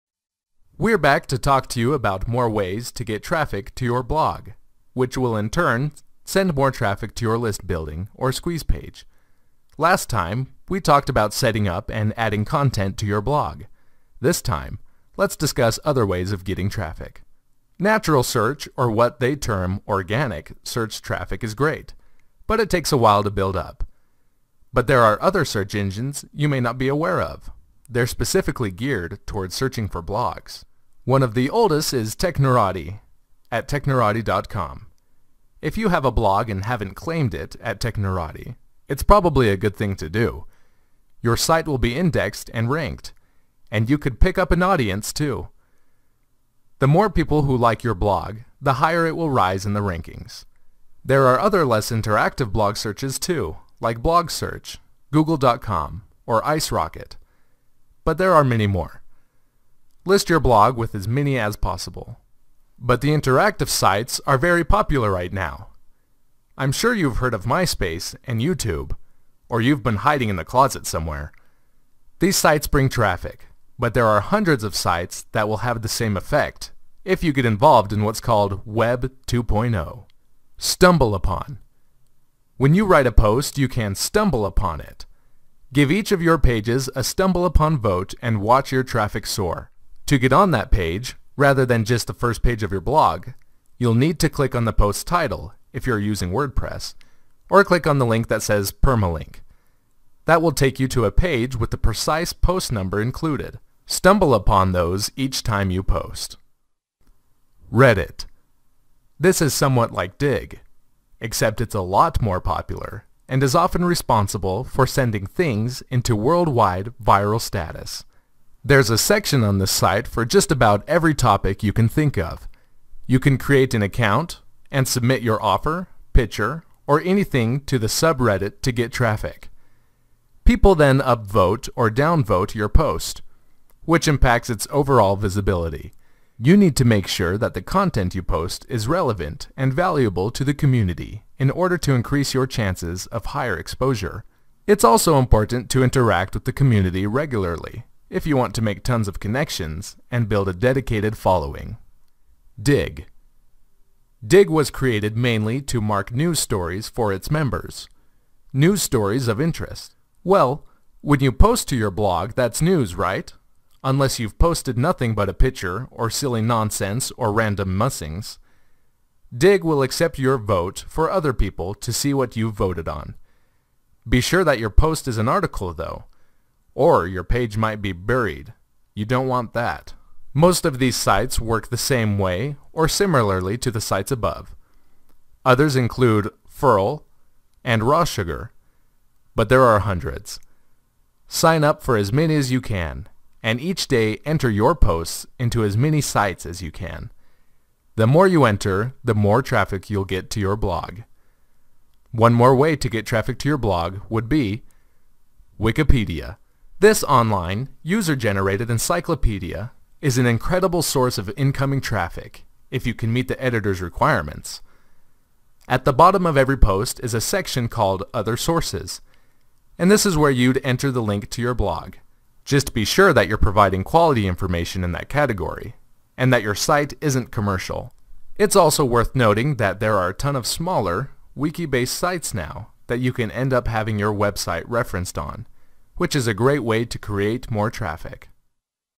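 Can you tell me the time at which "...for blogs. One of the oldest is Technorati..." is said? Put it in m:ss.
0:29.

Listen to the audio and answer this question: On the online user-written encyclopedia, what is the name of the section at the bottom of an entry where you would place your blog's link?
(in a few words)
Other Sources.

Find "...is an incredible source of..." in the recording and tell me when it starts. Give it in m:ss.
3:30.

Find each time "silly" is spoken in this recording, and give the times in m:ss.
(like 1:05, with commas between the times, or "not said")
2:46.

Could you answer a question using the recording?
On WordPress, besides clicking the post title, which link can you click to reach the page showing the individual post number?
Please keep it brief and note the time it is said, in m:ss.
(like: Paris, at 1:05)
permalink, at 1:38.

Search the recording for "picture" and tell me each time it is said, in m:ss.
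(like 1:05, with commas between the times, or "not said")
2:06, 2:45.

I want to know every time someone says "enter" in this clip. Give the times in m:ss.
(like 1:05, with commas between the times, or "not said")
3:14, 3:18, 3:40.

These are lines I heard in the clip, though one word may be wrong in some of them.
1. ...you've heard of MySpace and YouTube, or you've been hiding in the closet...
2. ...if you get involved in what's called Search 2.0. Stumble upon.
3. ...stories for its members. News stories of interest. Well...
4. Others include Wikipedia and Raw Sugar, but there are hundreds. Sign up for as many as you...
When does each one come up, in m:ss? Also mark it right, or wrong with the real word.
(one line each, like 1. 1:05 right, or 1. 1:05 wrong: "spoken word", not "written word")
1. 1:06 right
2. 1:17 wrong: "Web", not "Search"
3. 2:36 right
4. 3:05 wrong: "Furl", not "Wikipedia".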